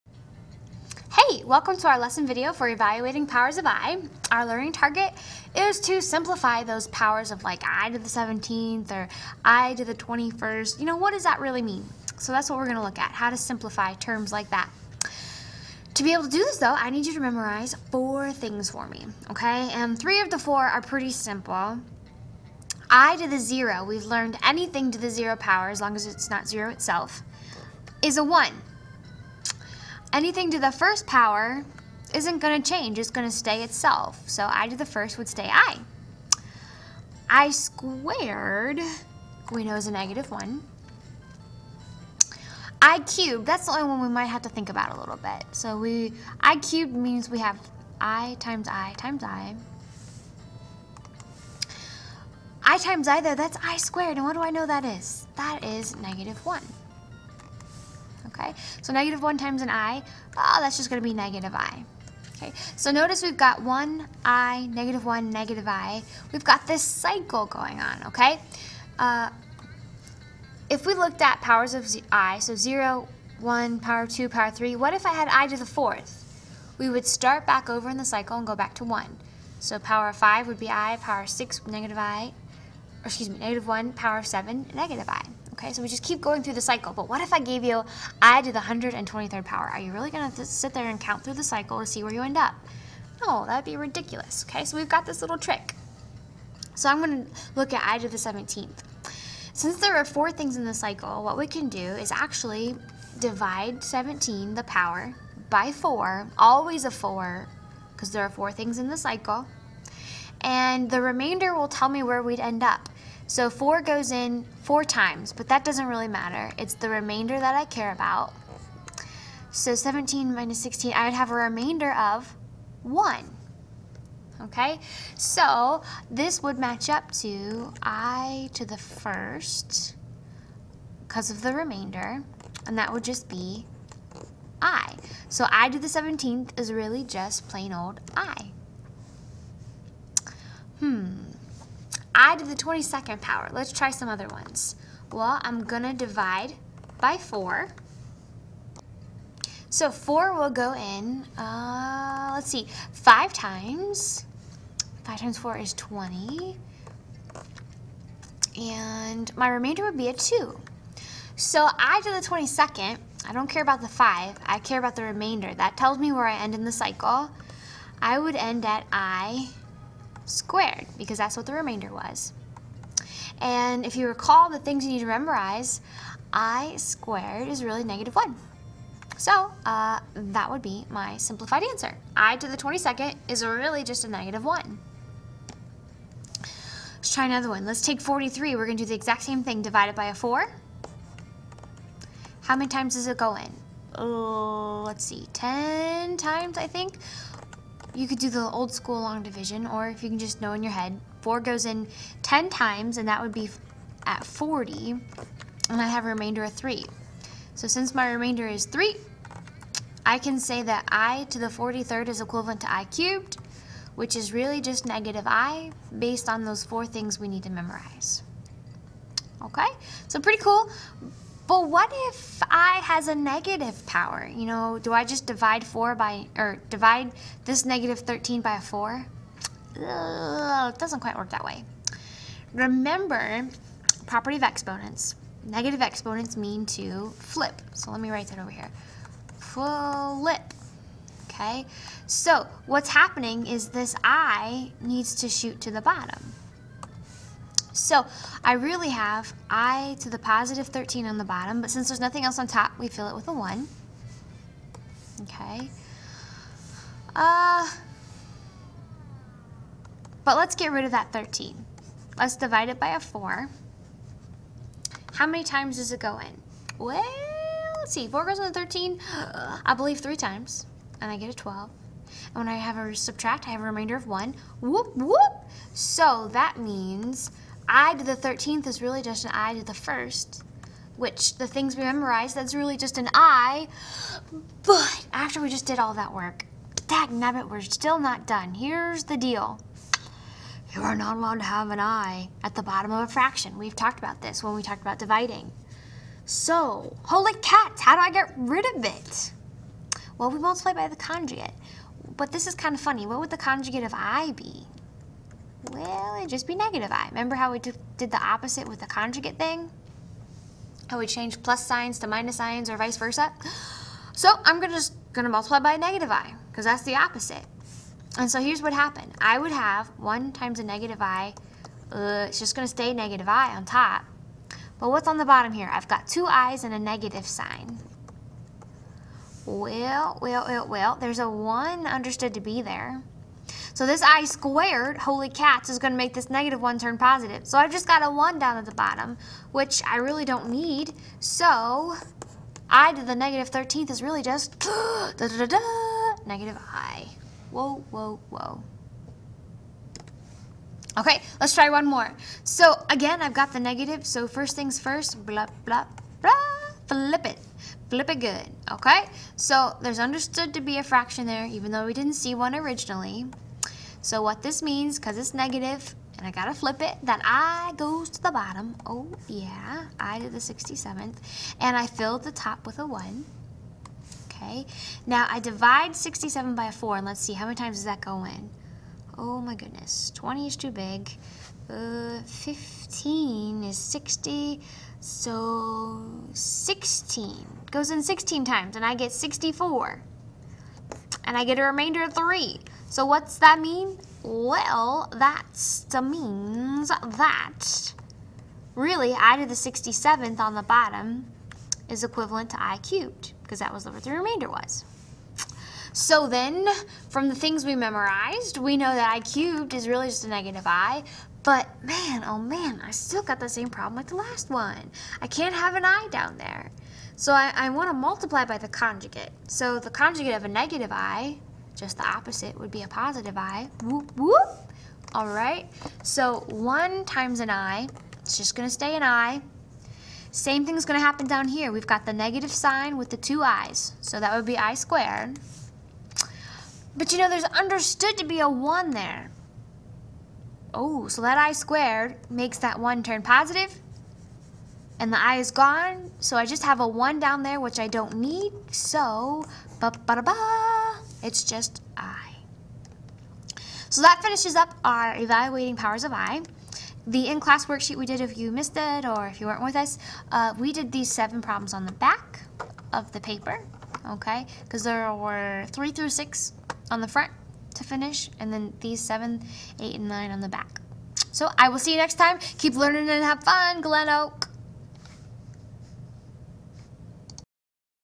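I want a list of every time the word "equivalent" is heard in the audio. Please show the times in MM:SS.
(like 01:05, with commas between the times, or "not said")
03:32, 06:42.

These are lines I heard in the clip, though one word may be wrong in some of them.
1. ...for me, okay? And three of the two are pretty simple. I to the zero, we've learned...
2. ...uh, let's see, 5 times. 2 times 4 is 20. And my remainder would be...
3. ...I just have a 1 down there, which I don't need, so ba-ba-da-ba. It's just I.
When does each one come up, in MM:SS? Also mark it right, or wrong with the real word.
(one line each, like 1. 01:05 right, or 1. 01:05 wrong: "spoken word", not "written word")
1. 00:18 wrong: "four", not "two"
2. 02:31 wrong: "5", not "2"
3. 07:26 right.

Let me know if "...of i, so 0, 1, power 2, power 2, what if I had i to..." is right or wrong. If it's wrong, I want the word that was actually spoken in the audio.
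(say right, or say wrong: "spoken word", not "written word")
wrong: "3", not "2".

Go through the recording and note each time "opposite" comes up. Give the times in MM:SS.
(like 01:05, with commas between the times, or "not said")
05:08, 05:16, 07:02.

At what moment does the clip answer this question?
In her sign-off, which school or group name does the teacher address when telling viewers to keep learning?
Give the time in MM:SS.
07:53.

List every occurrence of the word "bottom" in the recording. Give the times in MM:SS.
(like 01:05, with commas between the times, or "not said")
04:05, 04:11, 04:52, 05:25, 05:38, 06:08, 06:40.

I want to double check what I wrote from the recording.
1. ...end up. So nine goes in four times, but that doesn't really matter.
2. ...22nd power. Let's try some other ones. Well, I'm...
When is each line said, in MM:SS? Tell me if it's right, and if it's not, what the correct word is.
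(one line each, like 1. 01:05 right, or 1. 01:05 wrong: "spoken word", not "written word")
1. 01:52 wrong: "four", not "nine"
2. 02:22 right.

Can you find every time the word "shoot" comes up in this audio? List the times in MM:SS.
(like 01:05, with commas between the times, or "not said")
04:05.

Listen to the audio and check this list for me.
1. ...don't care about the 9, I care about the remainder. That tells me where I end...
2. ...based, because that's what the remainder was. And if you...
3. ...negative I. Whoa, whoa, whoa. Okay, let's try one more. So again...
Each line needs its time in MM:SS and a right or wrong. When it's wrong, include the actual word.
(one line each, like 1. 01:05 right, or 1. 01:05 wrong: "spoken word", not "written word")
1. 02:43 wrong: "5", not "9"
2. 02:50 wrong: "squared", not "based"
3. 05:46 right.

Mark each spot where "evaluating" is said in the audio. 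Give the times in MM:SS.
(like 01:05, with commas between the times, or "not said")
00:02, 07:35.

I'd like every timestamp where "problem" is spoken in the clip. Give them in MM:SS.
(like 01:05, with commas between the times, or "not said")
06:53, 07:41.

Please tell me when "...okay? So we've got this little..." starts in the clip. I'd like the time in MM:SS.
01:34.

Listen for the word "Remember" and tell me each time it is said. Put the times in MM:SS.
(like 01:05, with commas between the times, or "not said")
03:52, 05:07.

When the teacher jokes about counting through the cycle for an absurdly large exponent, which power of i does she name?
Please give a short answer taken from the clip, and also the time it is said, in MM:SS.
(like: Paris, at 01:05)
123rd, at 01:28.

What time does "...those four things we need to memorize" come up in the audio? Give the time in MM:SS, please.
03:36.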